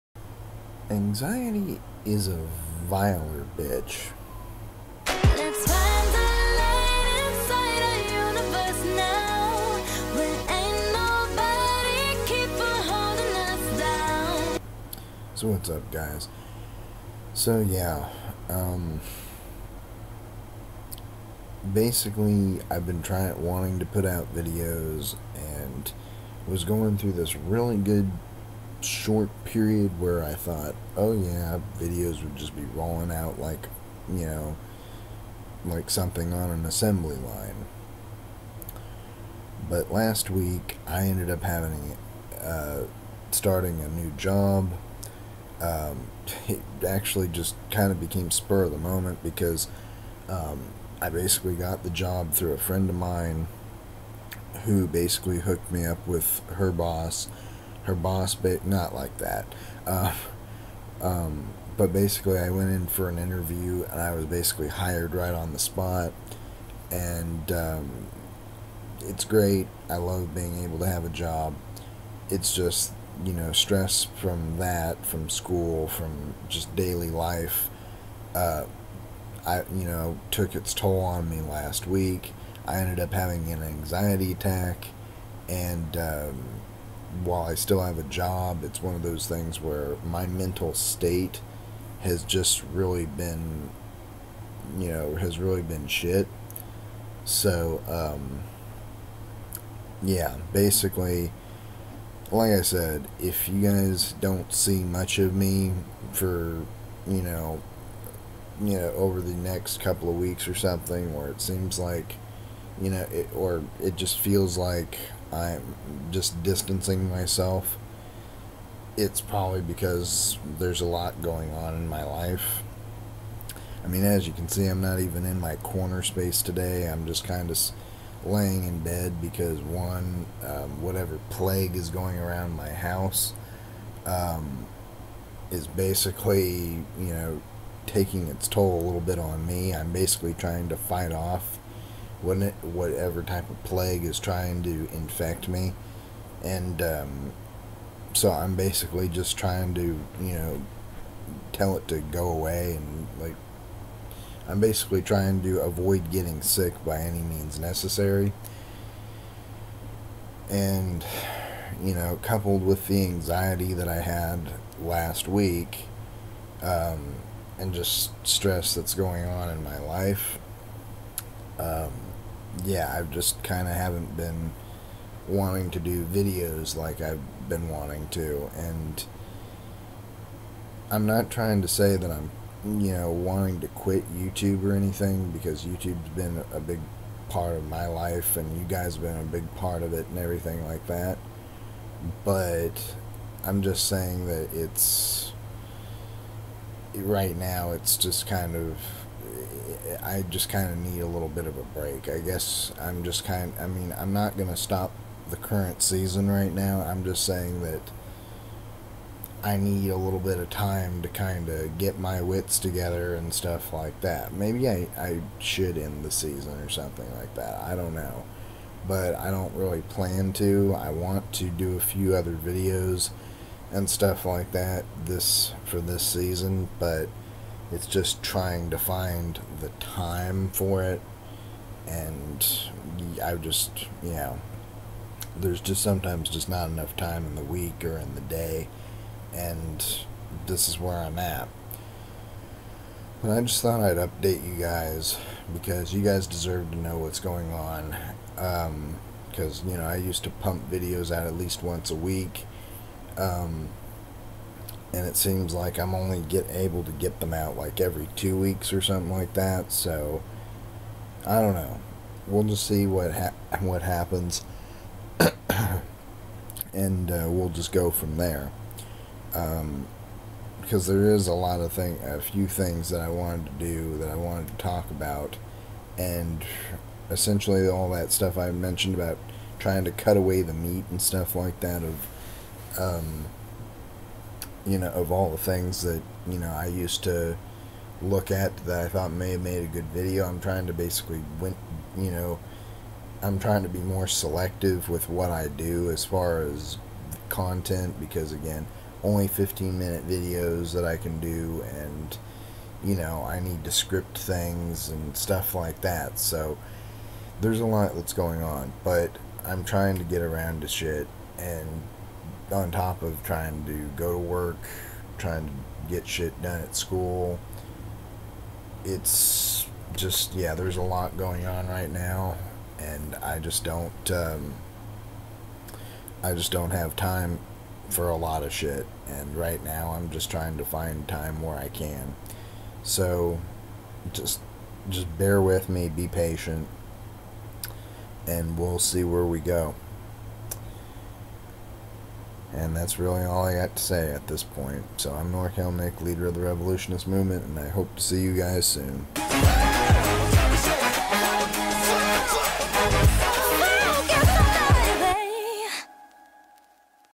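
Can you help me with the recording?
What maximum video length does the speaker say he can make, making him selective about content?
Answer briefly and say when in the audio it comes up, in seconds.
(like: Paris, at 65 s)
15 minutes, at 299 s.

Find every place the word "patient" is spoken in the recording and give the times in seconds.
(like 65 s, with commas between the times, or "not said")
336 s.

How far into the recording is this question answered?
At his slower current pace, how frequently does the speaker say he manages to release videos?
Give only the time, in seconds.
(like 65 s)
257 s.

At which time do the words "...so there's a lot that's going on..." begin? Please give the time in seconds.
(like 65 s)
306 s.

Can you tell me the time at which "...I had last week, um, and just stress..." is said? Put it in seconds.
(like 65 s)
163 s.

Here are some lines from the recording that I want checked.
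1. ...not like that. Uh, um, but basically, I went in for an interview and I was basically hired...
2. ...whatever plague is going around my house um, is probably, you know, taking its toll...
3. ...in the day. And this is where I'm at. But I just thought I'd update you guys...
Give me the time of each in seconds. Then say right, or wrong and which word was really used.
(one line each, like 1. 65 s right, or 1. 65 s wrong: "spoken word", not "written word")
1. 58 s right
2. 130 s wrong: "basically", not "probably"
3. 237 s right.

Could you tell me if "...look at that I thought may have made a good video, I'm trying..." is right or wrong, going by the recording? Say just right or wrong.
right.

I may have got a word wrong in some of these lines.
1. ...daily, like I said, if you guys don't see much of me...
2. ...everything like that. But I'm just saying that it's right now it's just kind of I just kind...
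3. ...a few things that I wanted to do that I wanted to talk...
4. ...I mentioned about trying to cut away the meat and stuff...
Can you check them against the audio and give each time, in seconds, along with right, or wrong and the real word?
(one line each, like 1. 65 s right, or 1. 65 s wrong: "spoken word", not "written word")
1. 100 s wrong: "basically", not "daily"
2. 190 s right
3. 272 s right
4. 278 s right.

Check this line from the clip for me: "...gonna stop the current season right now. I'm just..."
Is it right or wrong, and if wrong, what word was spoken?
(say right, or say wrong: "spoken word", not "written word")
right.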